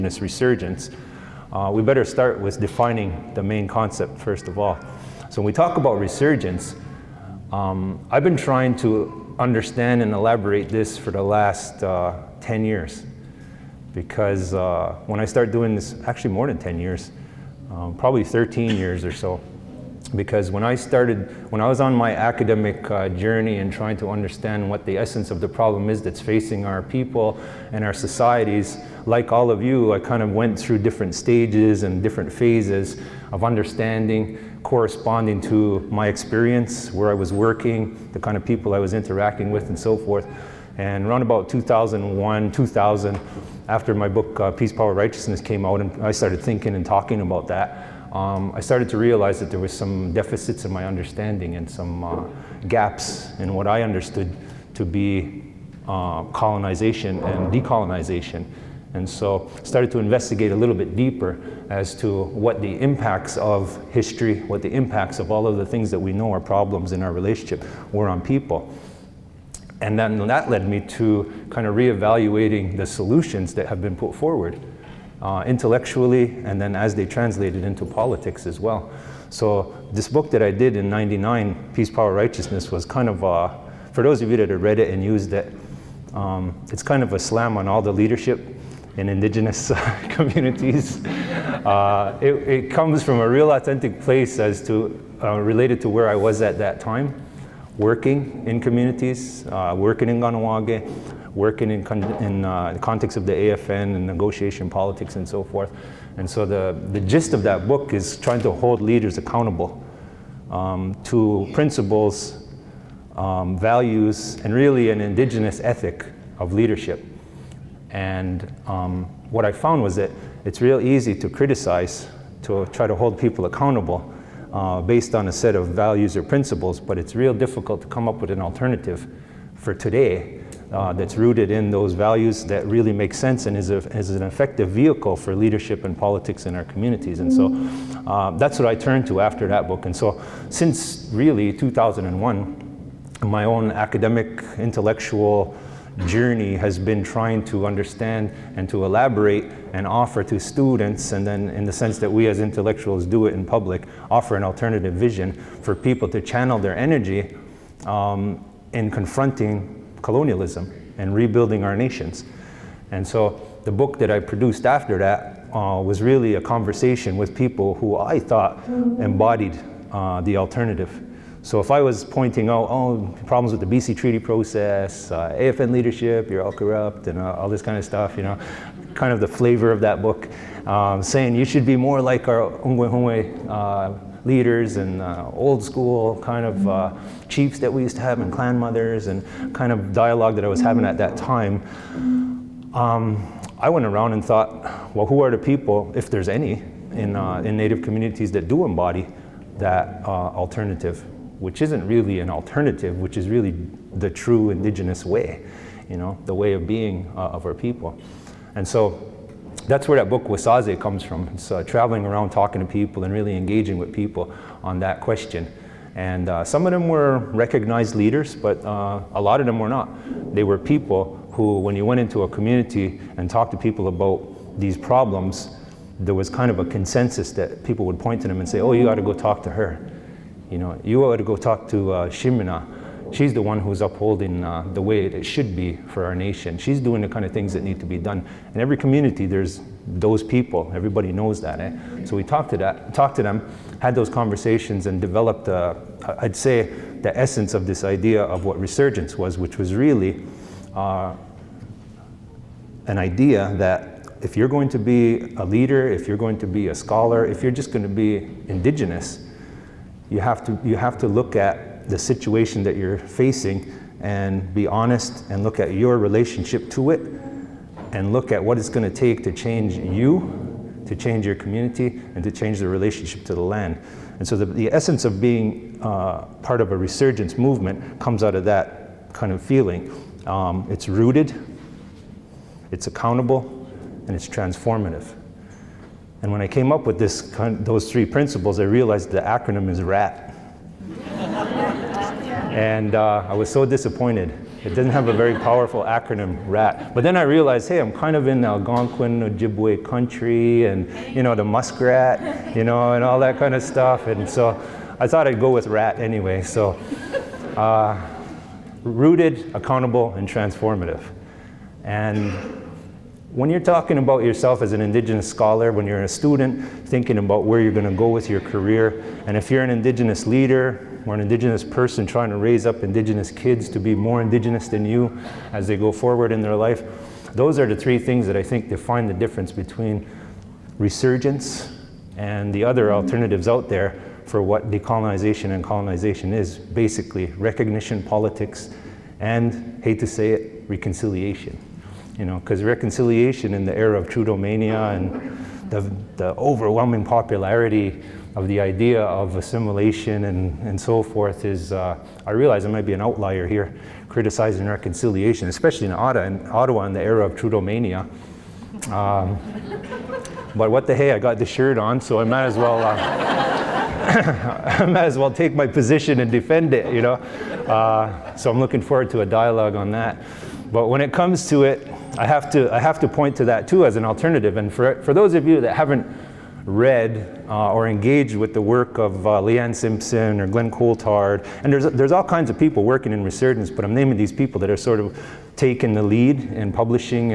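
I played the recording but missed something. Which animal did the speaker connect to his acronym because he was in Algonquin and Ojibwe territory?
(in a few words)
muskrat.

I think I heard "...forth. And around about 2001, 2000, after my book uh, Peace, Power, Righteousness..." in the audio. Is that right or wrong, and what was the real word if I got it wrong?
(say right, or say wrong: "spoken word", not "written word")
right.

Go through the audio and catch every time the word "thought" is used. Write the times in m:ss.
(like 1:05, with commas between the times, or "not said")
2:48, 3:14, 5:05.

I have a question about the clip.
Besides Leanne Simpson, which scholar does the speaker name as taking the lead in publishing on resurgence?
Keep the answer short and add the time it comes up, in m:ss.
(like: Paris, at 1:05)
Glenn Coulthard, at 6:20.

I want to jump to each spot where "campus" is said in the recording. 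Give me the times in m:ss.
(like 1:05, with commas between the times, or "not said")
not said.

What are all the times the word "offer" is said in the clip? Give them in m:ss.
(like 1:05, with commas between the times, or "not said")
2:29, 2:34.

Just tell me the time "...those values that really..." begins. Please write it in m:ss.
2:11.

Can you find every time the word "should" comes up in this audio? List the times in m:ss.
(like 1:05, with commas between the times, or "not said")
3:01, 3:55.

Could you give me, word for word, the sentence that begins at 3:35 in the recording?
And uh, some of them were recognized leaders, but uh, a lot of them were not.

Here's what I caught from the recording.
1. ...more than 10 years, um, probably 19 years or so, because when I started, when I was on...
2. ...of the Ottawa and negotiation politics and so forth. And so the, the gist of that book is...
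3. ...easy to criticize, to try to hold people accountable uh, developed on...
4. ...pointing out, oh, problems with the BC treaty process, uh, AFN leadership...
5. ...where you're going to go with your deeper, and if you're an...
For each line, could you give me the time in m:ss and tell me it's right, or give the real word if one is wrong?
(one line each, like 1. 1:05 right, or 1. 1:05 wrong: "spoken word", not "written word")
1. 0:16 wrong: "13", not "19"
2. 1:43 wrong: "AFN", not "Ottawa"
3. 2:00 wrong: "based", not "developed"
4. 2:52 right
5. 5:17 wrong: "career", not "deeper".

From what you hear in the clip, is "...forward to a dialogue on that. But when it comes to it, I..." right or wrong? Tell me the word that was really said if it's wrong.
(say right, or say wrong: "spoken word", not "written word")
right.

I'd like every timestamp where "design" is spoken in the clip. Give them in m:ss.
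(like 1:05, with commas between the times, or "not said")
not said.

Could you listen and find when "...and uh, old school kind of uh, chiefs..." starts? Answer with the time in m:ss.
3:04.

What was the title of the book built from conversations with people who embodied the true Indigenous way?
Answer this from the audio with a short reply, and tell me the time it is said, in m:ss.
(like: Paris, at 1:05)
Wasáse, at 3:30.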